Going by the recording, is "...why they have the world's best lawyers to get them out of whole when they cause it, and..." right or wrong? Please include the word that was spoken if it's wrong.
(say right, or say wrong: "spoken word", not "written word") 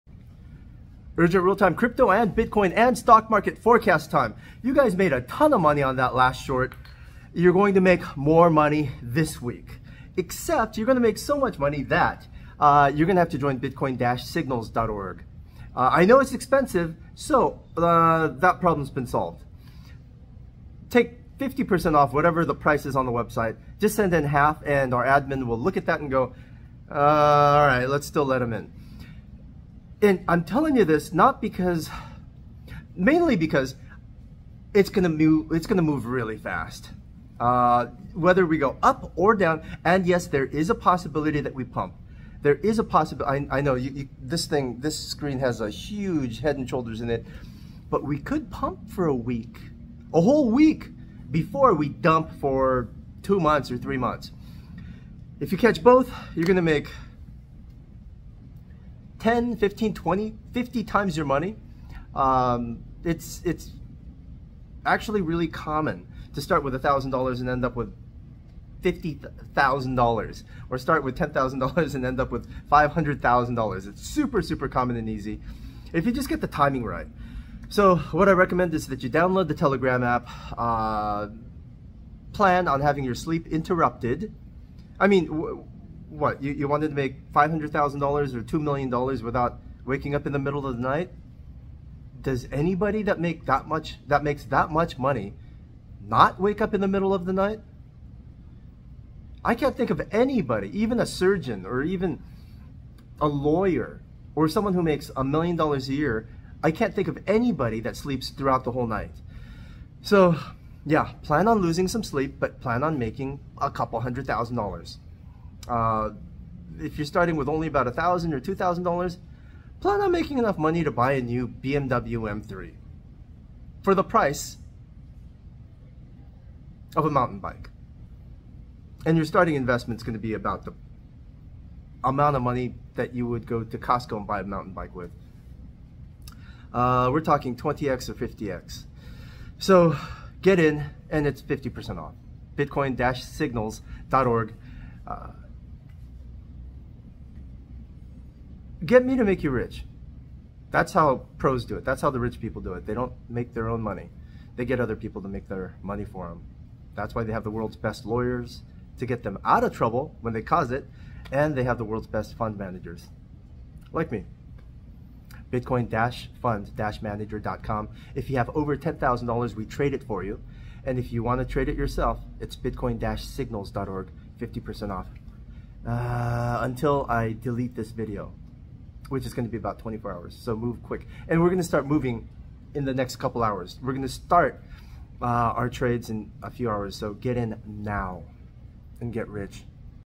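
wrong: "trouble", not "whole".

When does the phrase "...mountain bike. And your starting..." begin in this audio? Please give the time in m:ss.
2:07.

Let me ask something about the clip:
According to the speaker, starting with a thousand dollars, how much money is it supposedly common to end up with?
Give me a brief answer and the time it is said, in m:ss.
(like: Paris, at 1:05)
$50,000, at 1:08.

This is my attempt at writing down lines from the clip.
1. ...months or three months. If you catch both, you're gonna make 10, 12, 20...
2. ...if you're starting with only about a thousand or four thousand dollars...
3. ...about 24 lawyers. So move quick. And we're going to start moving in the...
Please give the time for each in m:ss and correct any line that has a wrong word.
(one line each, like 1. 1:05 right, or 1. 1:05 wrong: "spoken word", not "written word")
1. 0:53 wrong: "15", not "12"
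2. 1:56 wrong: "two", not "four"
3. 2:59 wrong: "hours", not "lawyers".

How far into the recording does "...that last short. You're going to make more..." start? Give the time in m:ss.
0:05.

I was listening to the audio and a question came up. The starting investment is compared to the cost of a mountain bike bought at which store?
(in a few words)
Costco.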